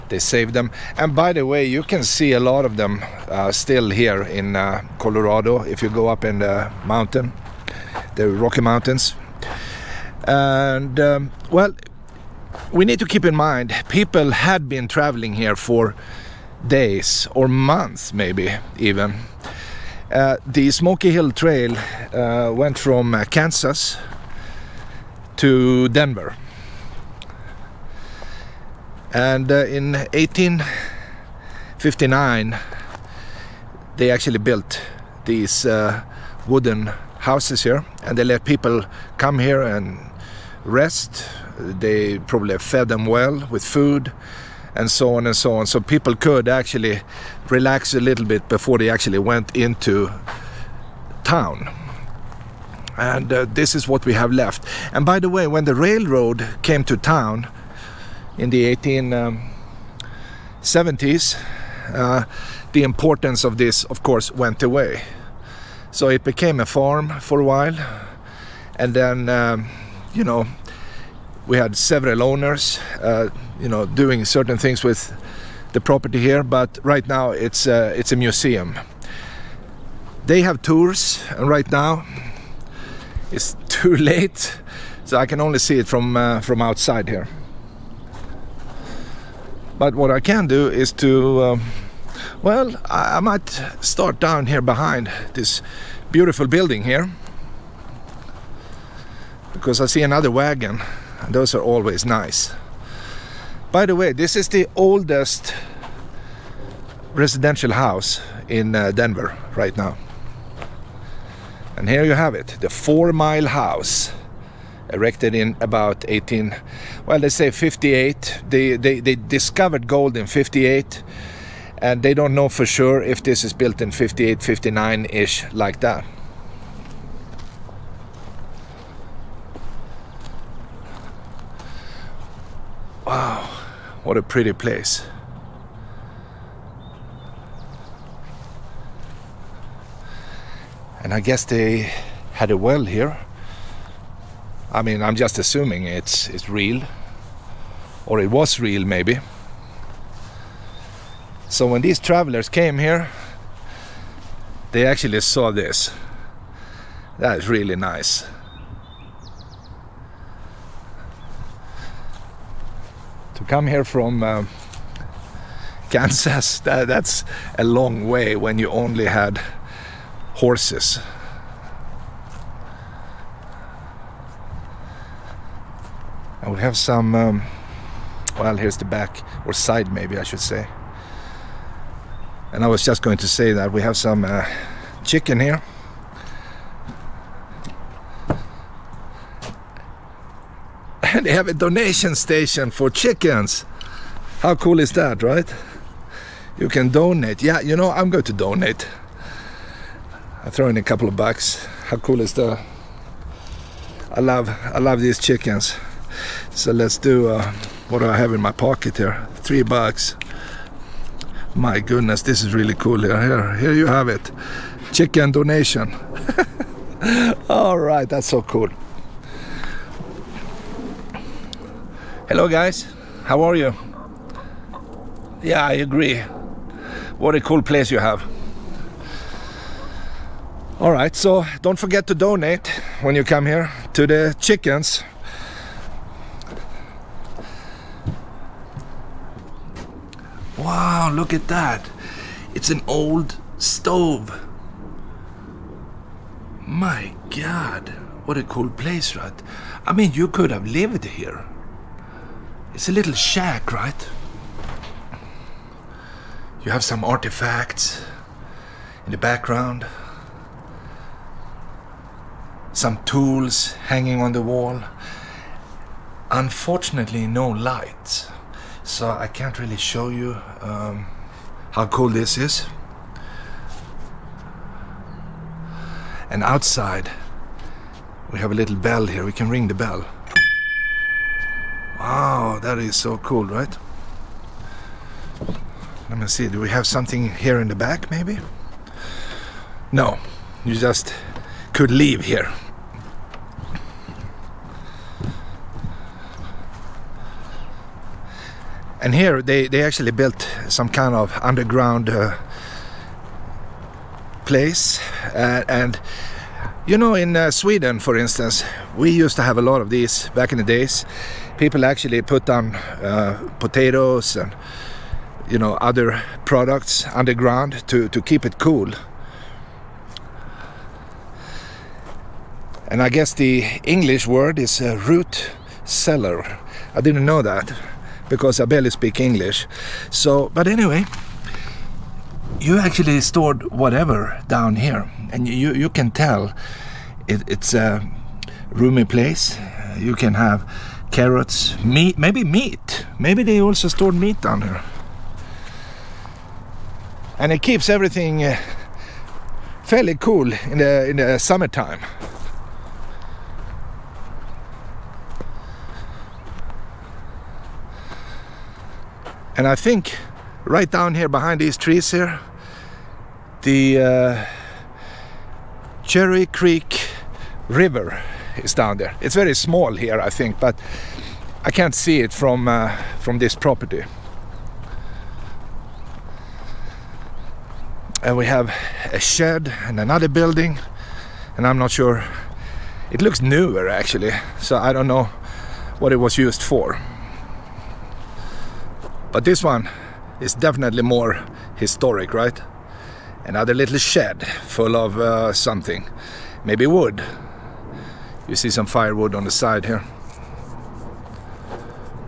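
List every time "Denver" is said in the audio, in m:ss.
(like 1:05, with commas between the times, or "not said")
0:25, 1:48.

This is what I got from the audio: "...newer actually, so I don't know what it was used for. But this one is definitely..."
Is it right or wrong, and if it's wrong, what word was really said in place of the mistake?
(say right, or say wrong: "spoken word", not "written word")
right.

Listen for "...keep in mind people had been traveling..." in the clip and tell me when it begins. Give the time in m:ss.
0:13.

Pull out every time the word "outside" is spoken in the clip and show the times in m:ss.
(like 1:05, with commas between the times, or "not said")
1:26, 4:36.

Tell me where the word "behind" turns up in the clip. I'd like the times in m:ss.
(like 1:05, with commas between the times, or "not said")
1:34, 6:01.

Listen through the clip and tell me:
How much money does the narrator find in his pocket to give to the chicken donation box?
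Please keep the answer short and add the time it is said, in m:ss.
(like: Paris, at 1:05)
$3, at 3:29.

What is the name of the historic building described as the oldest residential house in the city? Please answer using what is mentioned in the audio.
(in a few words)
Four Mile House.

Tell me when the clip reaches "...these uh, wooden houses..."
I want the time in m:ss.
0:35.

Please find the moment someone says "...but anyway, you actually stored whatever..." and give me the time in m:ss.
5:30.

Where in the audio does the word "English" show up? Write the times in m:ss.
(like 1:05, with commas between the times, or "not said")
5:23, 5:29.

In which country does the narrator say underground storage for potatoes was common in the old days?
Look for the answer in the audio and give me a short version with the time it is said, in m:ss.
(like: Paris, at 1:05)
Sweden, at 5:07.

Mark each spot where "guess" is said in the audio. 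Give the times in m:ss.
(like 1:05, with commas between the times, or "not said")
2:21, 5:23.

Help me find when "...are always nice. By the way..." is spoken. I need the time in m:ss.
1:41.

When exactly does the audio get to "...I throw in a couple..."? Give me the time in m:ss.
3:20.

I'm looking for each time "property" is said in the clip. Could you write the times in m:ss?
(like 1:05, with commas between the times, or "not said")
1:15, 6:13.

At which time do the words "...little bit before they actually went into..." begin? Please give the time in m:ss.
0:47.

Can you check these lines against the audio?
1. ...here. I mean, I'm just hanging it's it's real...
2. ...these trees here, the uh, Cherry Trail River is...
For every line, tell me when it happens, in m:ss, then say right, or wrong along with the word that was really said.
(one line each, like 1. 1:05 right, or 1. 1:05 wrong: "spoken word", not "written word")
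1. 2:22 wrong: "assuming", not "hanging"
2. 6:01 wrong: "Creek", not "Trail".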